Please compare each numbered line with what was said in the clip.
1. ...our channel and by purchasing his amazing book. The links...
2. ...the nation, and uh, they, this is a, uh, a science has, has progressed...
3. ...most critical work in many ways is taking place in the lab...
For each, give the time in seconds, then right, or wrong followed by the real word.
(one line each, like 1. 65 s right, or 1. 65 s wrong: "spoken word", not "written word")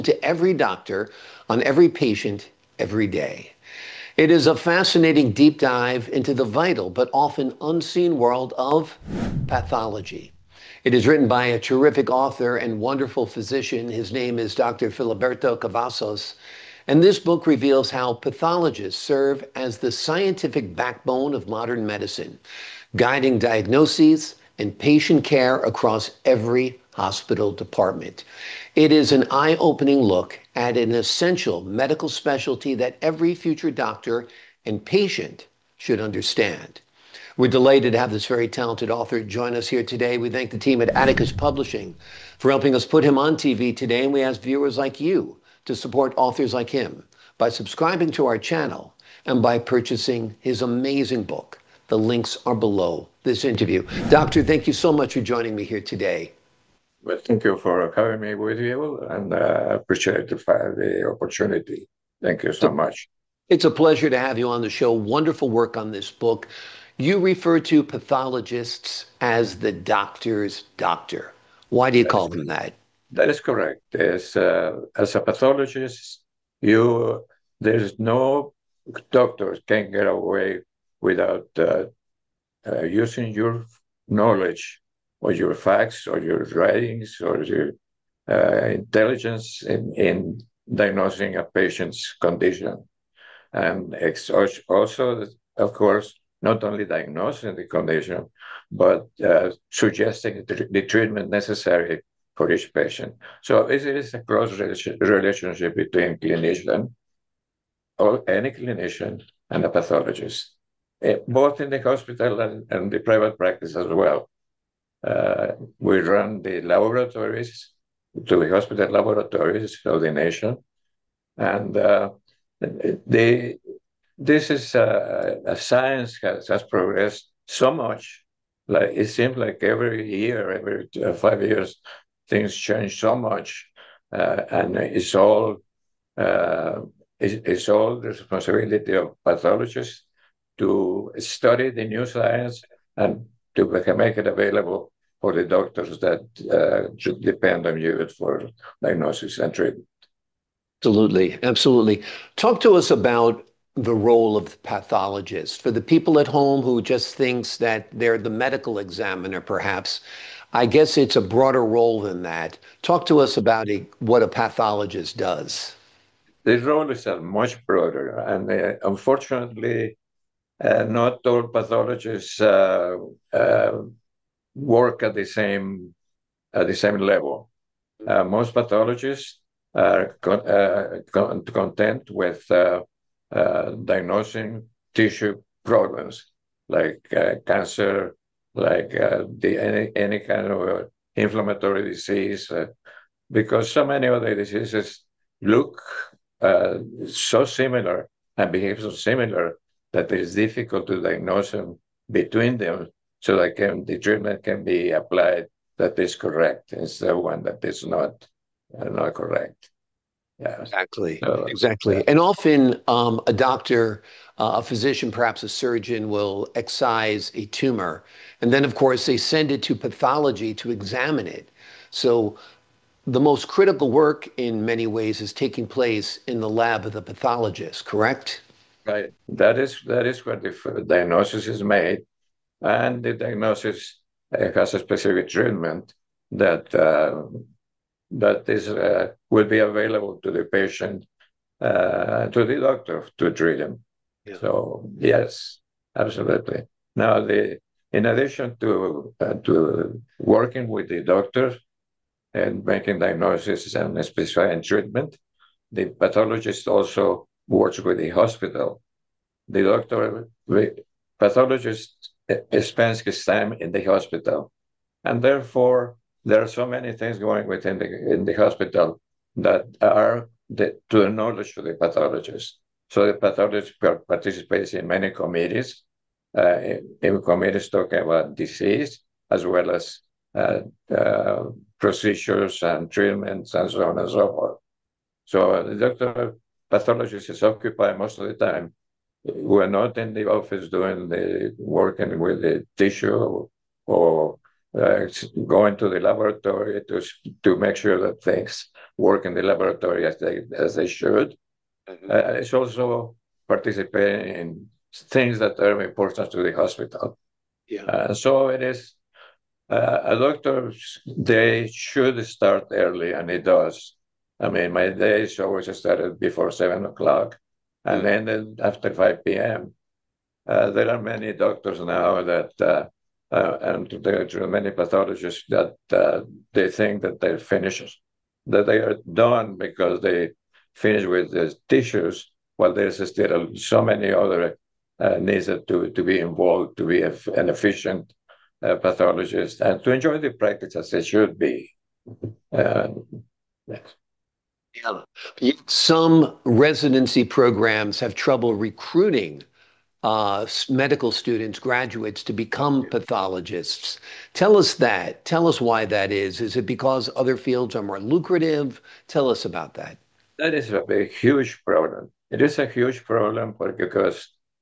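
1. 48 s right
2. 120 s right
3. 223 s right.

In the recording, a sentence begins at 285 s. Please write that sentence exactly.
So the doctor pathologist is occupied most of the time.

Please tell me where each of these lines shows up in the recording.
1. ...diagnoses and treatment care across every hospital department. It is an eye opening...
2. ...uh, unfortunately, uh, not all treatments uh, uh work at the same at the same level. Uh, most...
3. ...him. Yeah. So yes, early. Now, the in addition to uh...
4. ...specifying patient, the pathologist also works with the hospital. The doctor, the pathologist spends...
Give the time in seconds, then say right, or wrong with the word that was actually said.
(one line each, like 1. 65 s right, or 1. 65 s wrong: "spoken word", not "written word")
1. 23 s wrong: "patient", not "treatment"
2. 168 s wrong: "pathologists", not "treatments"
3. 243 s wrong: "absolutely", not "early"
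4. 254 s wrong: "treatment", not "patient".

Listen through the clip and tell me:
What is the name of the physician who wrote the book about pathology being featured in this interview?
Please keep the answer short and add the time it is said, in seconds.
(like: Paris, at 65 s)
Filiberto Cavazos, at 14 s.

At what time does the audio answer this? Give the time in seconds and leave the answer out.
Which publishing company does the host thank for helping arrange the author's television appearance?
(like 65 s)
40 s.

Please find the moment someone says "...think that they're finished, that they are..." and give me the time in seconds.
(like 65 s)
326 s.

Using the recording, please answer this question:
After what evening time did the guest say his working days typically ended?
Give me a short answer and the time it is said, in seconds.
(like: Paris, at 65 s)
5 p.m., at 318 s.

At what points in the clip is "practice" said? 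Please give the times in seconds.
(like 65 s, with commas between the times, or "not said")
113 s, 340 s.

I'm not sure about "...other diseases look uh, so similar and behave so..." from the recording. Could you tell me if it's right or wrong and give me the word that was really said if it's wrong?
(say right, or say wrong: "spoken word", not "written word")
right.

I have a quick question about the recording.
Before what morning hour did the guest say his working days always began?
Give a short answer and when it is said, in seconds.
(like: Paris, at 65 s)
7 o'clock, at 316 s.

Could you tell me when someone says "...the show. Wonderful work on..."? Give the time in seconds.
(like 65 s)
64 s.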